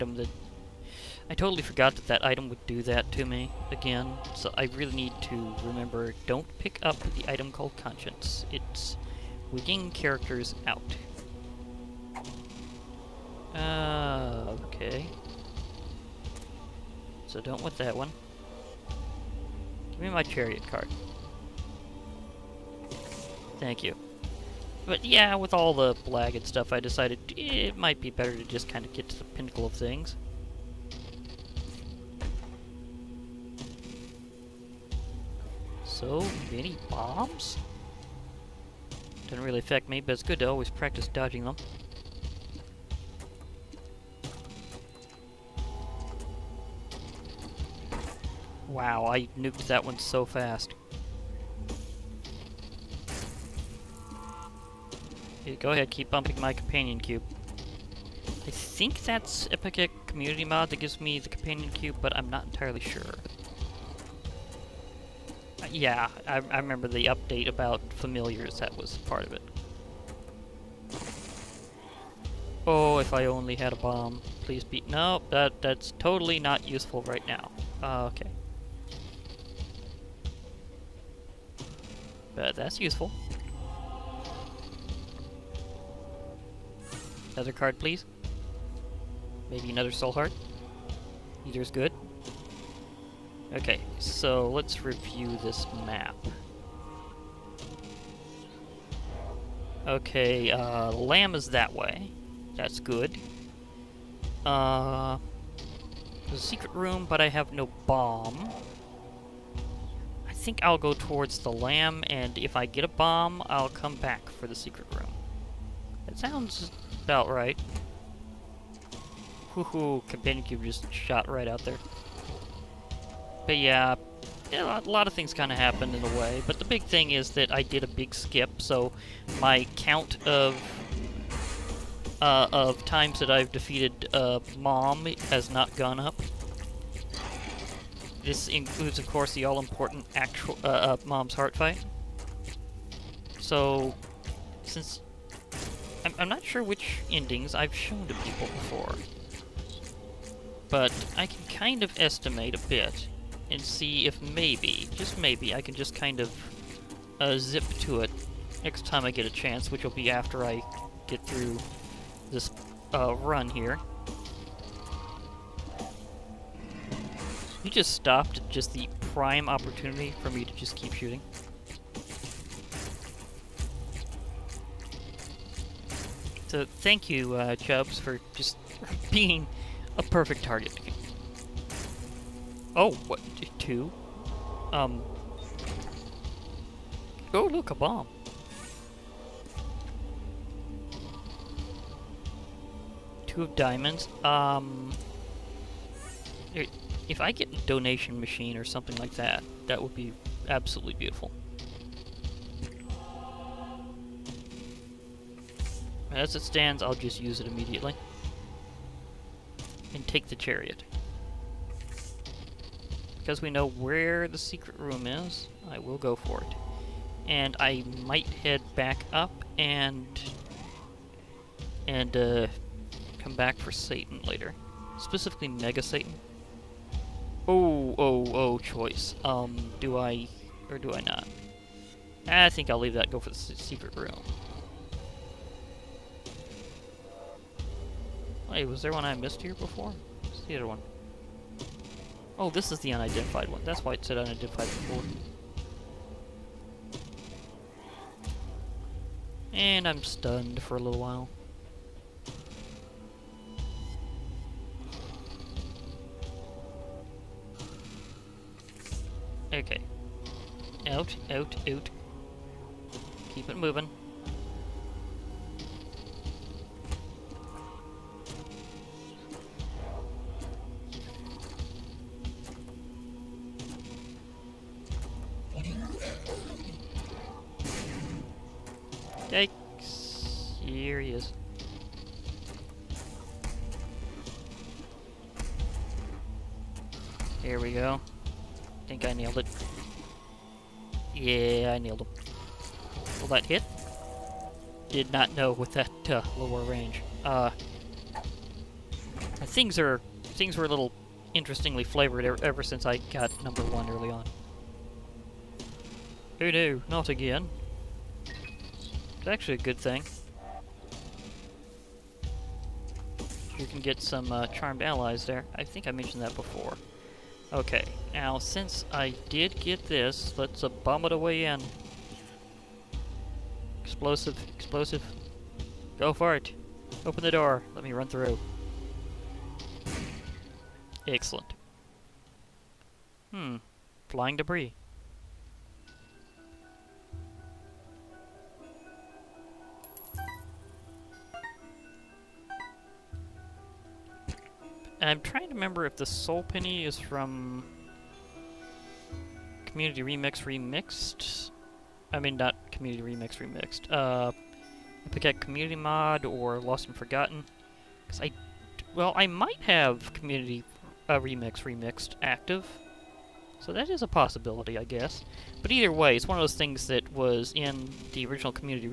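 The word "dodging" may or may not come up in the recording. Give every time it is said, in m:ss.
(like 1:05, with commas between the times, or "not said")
0:41.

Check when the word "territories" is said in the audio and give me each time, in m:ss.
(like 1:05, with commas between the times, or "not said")
not said.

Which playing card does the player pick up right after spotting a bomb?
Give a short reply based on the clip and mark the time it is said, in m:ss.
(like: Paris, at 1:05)
Two of diamonds, at 3:13.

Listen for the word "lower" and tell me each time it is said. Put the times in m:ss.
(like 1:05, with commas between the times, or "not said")
4:56.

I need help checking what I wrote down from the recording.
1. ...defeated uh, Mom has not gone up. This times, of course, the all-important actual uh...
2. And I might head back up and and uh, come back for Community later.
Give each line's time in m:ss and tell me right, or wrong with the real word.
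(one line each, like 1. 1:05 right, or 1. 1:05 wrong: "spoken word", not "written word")
1. 2:13 wrong: "includes", not "times"
2. 3:37 wrong: "Satan", not "Community".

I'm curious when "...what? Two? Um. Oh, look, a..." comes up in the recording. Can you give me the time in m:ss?
3:03.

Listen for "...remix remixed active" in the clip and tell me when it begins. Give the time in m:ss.
6:01.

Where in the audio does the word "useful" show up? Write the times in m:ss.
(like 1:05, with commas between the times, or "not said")
1:16, 1:22.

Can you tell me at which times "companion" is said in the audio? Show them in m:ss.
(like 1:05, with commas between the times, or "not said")
0:56, 1:01, 2:00.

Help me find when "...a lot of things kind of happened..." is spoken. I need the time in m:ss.
2:04.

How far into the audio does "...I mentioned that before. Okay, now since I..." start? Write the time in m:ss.
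5:15.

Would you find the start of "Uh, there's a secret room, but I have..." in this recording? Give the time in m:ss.
1:44.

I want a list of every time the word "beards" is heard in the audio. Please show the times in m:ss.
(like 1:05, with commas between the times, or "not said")
not said.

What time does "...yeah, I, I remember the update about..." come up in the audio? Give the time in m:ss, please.
1:05.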